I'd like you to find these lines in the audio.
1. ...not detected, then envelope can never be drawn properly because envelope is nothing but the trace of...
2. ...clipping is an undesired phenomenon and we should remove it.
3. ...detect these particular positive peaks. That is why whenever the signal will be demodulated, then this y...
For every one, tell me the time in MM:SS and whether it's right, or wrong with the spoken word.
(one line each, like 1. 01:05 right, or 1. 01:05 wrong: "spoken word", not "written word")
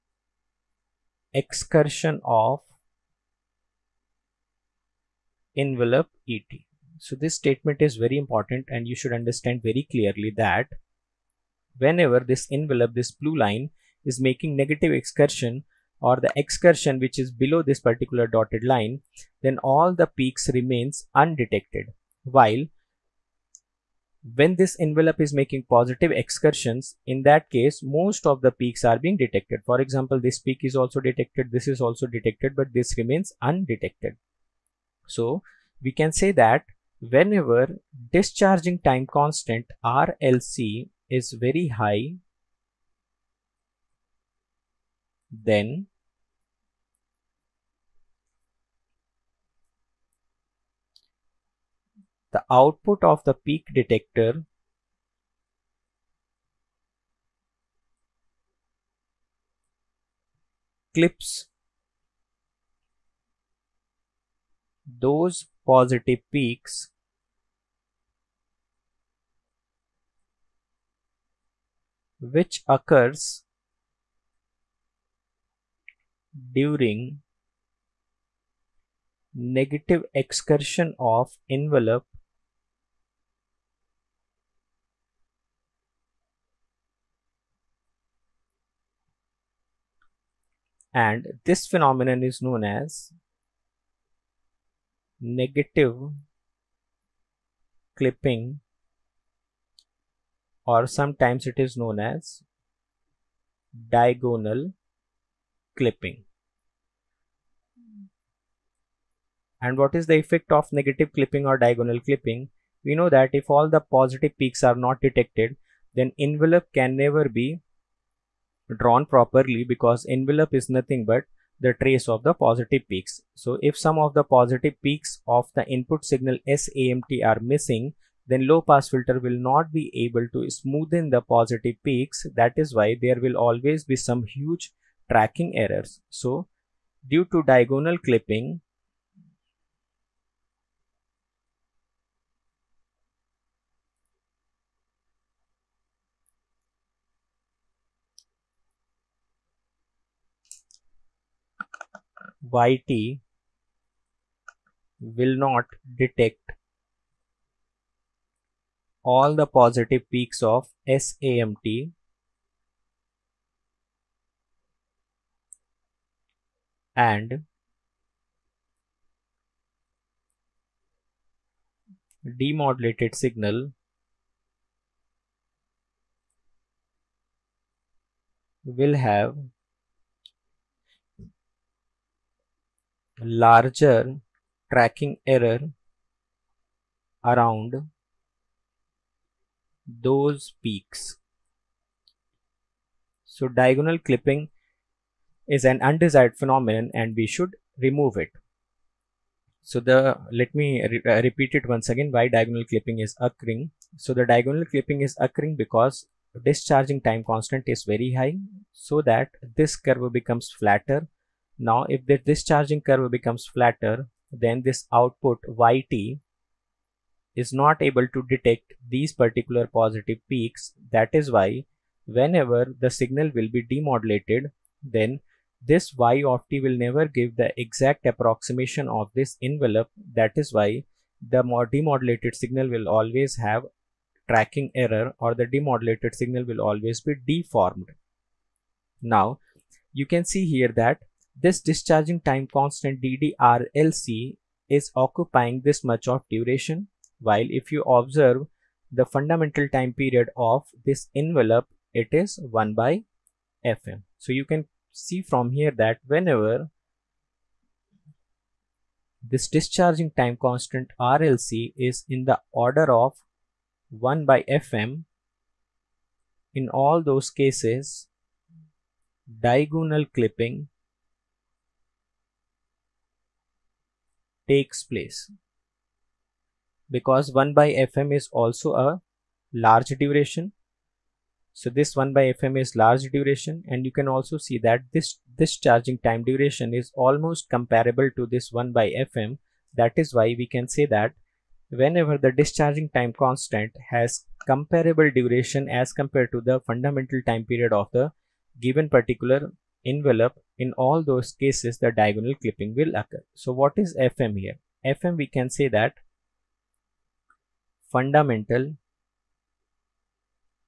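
1. 01:54 right
2. 03:13 right
3. 03:38 right.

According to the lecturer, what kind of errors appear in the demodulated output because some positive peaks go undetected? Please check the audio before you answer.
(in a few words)
tracking errors.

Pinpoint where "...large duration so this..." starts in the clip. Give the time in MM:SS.
04:39.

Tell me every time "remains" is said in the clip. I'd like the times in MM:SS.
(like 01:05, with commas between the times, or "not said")
00:20, 00:32.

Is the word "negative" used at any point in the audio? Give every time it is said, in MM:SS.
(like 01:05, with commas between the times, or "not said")
00:14, 01:19, 01:35, 01:50.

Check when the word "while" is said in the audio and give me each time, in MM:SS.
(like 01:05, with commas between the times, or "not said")
00:22, 04:07.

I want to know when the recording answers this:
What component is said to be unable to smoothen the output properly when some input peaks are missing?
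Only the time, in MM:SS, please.
02:08.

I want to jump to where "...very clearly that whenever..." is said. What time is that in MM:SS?
00:09.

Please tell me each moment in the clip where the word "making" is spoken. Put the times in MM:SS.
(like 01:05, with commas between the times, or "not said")
00:14, 00:25.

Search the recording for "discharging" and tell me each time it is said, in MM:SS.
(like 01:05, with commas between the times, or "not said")
00:38, 03:26, 03:32, 04:01, 04:19, 04:52.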